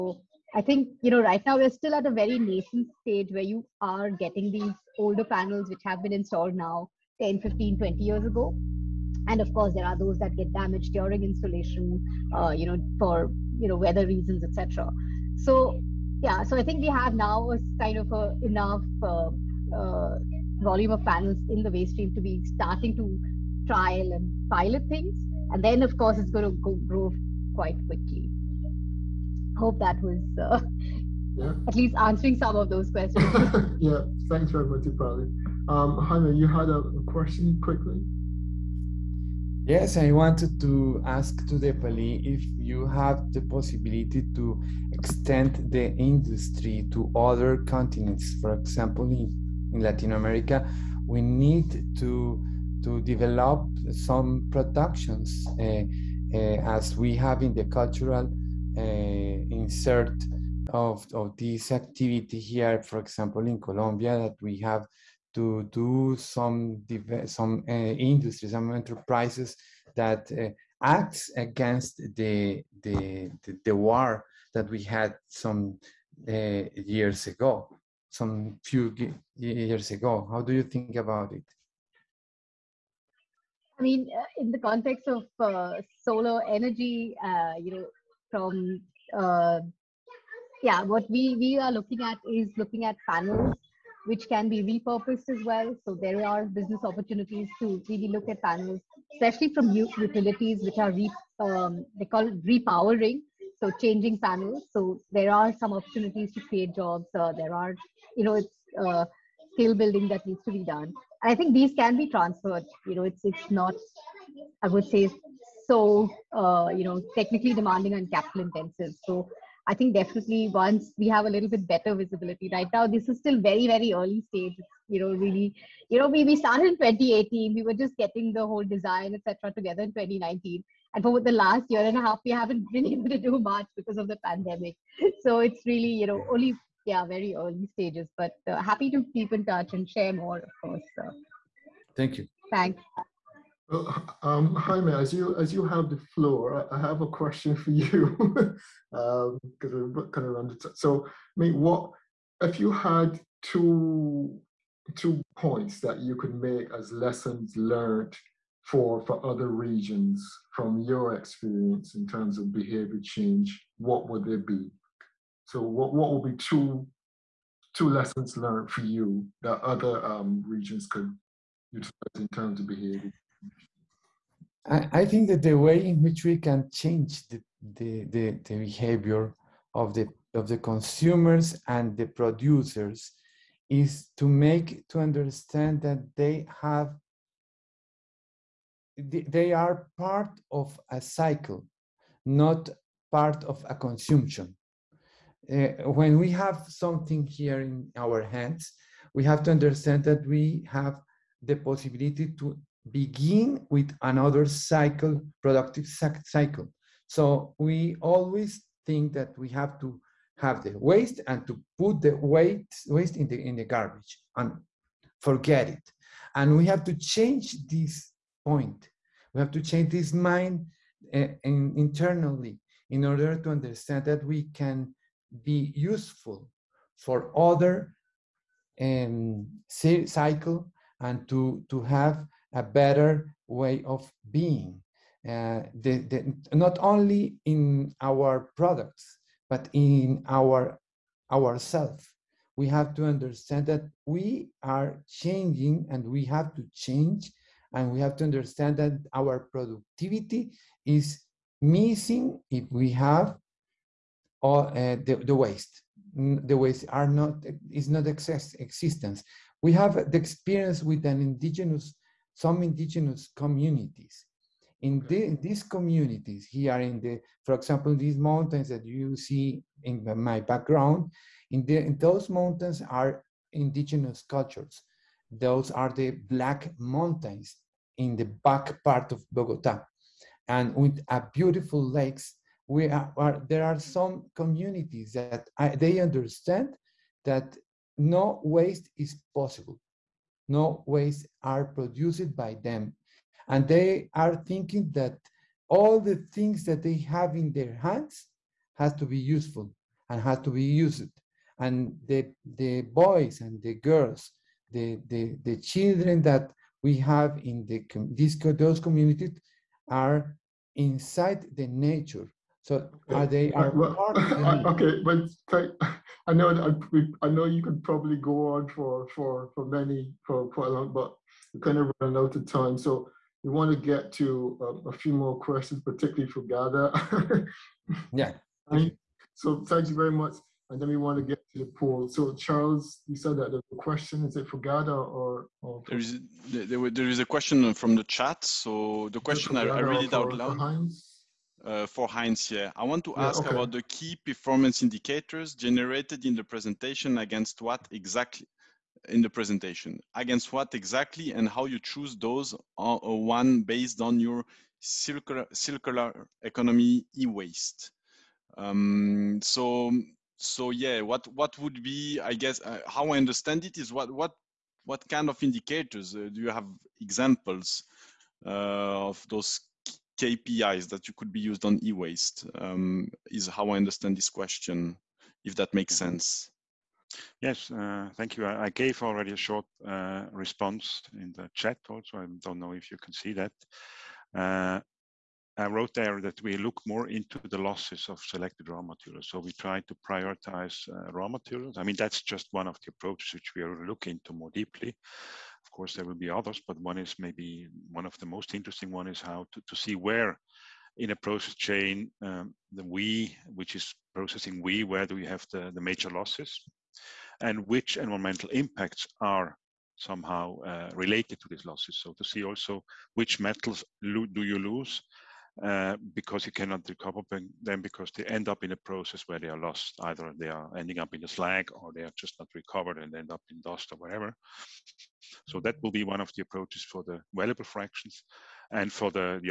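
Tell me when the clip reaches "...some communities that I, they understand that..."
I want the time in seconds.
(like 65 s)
283 s.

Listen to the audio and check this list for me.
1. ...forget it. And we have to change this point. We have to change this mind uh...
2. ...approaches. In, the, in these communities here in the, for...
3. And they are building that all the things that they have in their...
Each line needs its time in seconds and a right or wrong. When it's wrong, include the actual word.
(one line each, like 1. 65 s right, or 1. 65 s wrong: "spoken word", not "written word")
1. 215 s right
2. 263 s wrong: "communities", not "approaches"
3. 293 s wrong: "thinking", not "building".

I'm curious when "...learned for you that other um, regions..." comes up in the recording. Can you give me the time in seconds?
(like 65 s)
168 s.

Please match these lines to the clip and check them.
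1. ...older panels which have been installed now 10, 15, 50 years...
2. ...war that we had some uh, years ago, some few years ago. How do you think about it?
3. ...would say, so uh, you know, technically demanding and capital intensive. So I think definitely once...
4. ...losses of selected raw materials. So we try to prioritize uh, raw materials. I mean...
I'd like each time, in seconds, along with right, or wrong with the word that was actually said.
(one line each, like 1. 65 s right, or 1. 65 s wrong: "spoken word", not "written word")
1. 4 s wrong: "20", not "50"
2. 73 s right
3. 114 s right
4. 387 s right.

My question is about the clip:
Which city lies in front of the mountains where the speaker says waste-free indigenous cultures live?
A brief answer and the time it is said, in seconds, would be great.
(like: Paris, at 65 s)
Bogota, at 279 s.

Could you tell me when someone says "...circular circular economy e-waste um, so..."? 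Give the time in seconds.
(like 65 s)
354 s.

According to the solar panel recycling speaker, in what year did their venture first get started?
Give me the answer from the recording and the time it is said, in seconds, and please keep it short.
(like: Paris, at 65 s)
2018, at 126 s.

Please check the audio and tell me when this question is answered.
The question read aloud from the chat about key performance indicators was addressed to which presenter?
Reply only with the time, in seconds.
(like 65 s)
342 s.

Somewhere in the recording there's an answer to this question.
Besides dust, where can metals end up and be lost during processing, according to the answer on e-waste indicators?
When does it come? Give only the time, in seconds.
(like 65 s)
421 s.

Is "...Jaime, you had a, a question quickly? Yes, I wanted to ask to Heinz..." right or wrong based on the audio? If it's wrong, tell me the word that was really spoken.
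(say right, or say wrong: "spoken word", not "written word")
wrong: "Deepali", not "Heinz".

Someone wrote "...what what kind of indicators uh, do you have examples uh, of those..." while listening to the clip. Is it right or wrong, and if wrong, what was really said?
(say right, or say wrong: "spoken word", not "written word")
right.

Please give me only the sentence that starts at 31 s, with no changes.
at least answering some of those questions.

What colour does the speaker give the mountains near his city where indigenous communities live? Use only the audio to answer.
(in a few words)
black.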